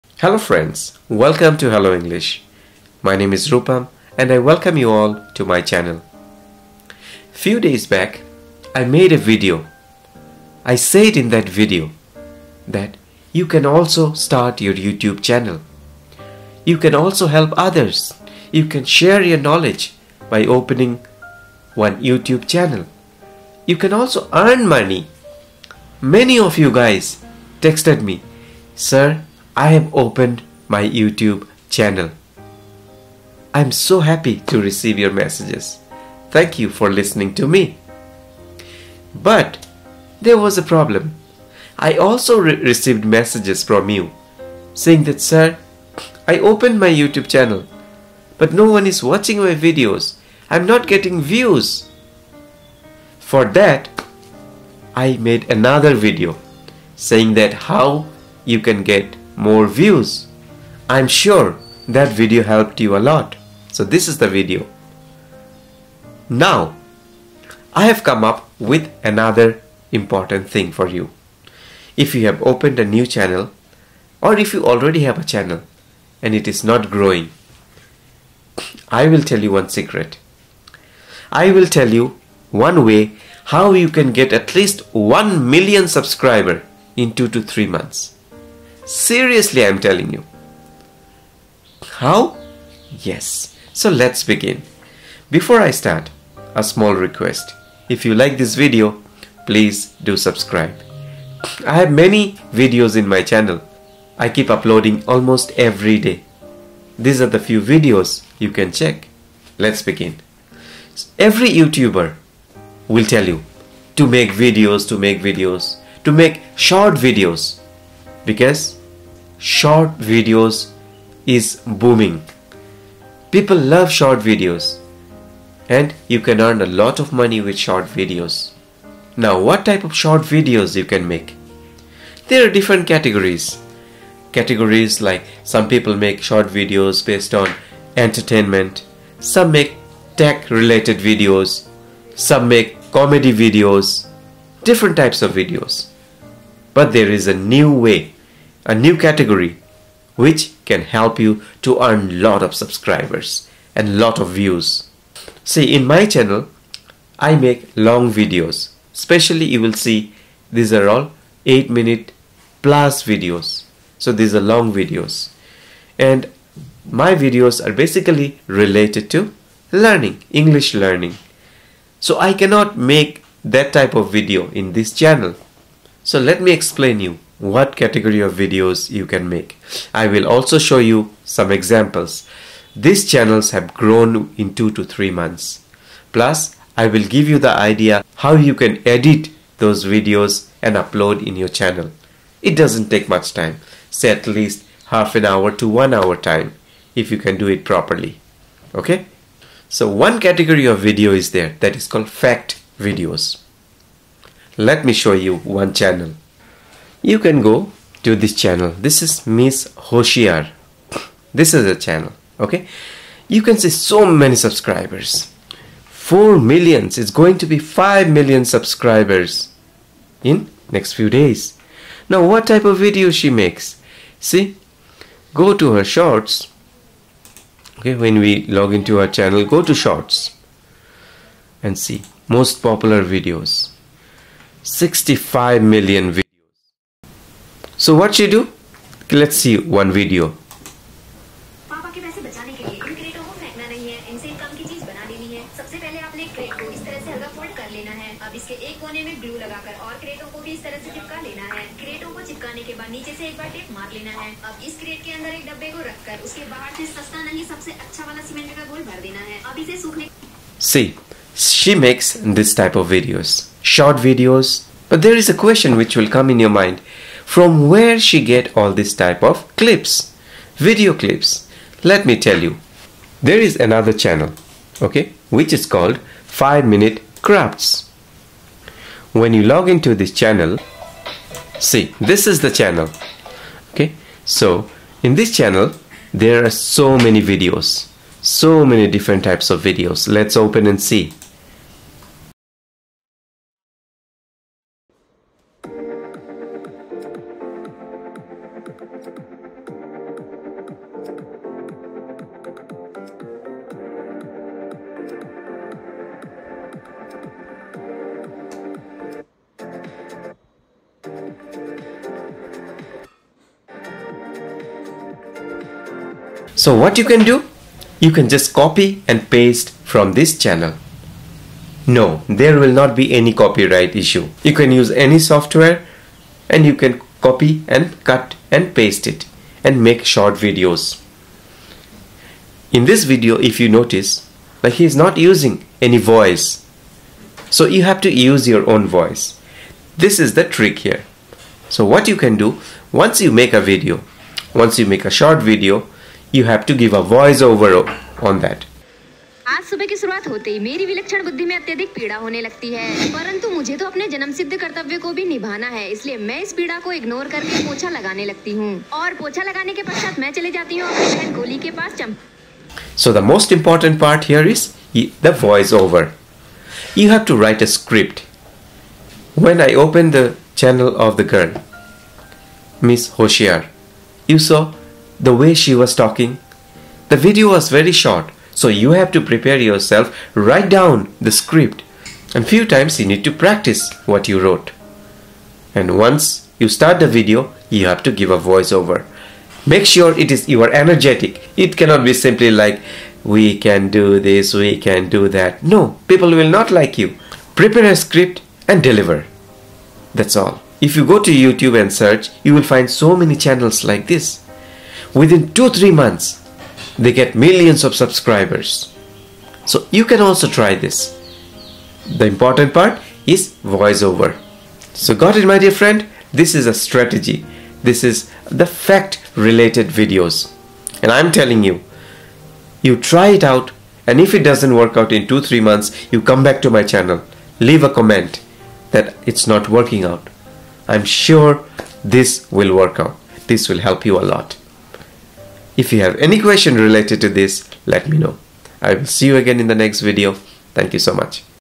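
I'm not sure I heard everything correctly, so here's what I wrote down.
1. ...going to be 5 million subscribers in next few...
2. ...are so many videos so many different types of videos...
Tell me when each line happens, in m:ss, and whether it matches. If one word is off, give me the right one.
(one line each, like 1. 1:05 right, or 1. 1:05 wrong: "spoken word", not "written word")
1. 3:37 right
2. 4:46 right.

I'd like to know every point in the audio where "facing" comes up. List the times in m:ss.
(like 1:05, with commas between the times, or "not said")
not said.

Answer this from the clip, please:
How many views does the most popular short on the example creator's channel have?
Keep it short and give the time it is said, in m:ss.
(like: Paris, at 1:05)
65 million, at 3:54.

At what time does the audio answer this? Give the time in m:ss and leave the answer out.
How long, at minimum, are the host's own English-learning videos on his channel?
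2:41.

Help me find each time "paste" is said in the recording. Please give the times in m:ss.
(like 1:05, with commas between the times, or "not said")
5:19, 5:28.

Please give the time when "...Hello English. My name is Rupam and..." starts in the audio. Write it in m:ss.
0:01.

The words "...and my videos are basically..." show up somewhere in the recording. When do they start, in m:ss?
2:45.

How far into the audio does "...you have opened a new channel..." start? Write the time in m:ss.
1:12.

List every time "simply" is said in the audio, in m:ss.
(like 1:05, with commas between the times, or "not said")
6:32.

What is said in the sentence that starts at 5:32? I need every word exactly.
In this video, if you notice, But he's not using any voice.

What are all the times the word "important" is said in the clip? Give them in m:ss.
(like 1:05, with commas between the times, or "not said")
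1:09, 6:03, 6:52.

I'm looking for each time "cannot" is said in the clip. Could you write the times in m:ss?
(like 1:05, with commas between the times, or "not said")
2:52, 6:31.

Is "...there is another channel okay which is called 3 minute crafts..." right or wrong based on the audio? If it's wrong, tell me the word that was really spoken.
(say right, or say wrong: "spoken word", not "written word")
wrong: "5", not "3".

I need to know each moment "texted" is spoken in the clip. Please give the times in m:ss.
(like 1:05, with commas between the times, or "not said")
0:27.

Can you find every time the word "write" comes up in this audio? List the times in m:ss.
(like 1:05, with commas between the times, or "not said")
6:07, 6:20.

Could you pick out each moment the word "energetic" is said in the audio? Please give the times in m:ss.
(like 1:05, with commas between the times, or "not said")
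6:30.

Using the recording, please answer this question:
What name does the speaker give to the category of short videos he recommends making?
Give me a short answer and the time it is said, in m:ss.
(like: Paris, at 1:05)
fact videos, at 3:22.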